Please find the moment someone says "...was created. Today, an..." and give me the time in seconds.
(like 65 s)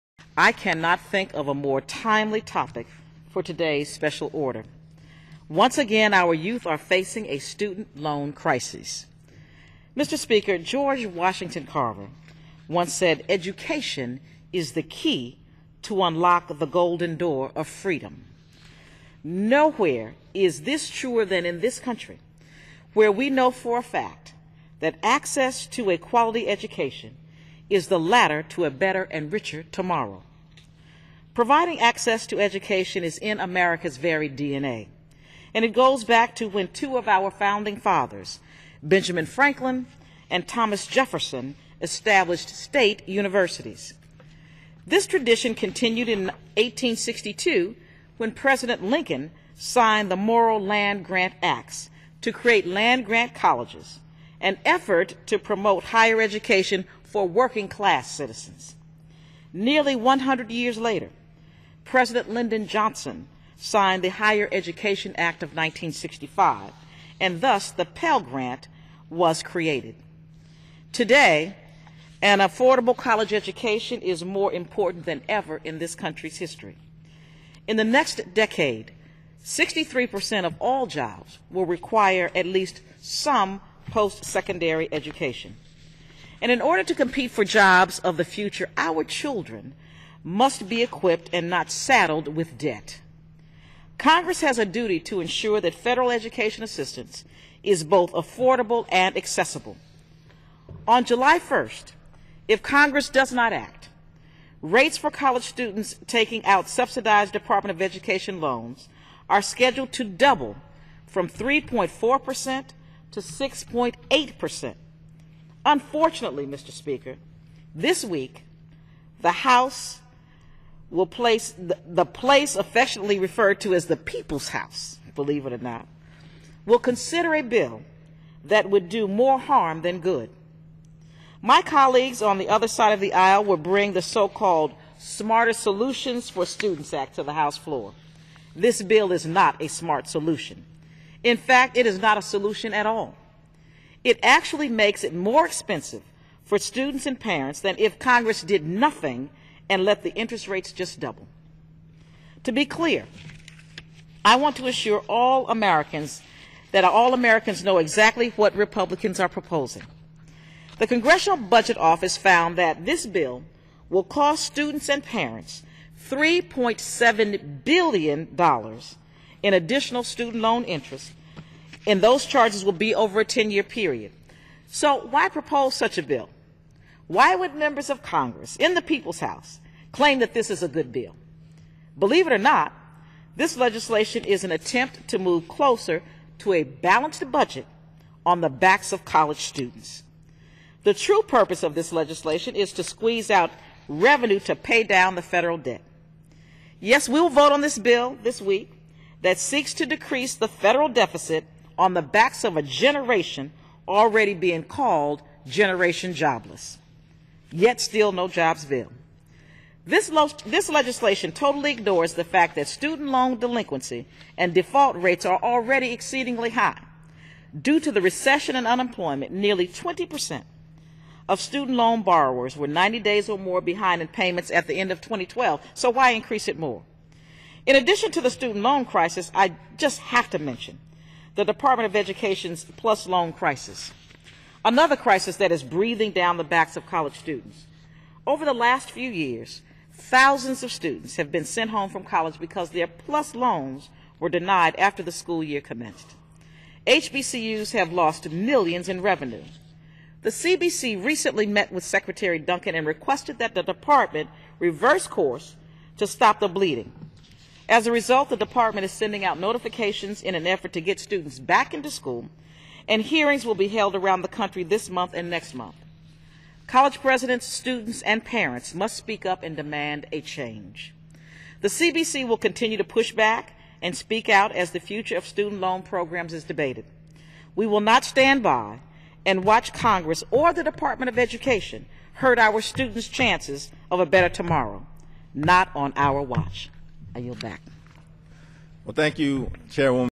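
69 s.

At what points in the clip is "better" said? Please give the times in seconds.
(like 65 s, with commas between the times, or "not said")
28 s, 284 s.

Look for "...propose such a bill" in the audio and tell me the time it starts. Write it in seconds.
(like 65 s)
175 s.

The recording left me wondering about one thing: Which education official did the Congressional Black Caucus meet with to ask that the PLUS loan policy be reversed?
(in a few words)
Secretary Duncan.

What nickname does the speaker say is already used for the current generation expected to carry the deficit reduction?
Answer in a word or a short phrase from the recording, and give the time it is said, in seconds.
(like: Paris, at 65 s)
Generation Jobless, at 205 s.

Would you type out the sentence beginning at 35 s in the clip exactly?
And it goes back to when two of our founding fathers, Benjamin Franklin and Thomas Jefferson, established state universities.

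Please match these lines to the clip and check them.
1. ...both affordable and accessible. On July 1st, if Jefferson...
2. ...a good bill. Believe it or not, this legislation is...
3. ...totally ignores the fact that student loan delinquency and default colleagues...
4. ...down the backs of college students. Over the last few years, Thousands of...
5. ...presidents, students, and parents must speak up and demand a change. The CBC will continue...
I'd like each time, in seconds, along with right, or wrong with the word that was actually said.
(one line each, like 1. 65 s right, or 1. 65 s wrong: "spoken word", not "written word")
1. 97 s wrong: "Congress", not "Jefferson"
2. 180 s right
3. 211 s wrong: "rates", not "colleagues"
4. 236 s right
5. 267 s right.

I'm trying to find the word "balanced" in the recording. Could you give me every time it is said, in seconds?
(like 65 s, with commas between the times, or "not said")
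186 s.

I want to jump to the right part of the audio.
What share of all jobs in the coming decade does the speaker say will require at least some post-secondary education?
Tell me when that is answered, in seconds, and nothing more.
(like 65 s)
79 s.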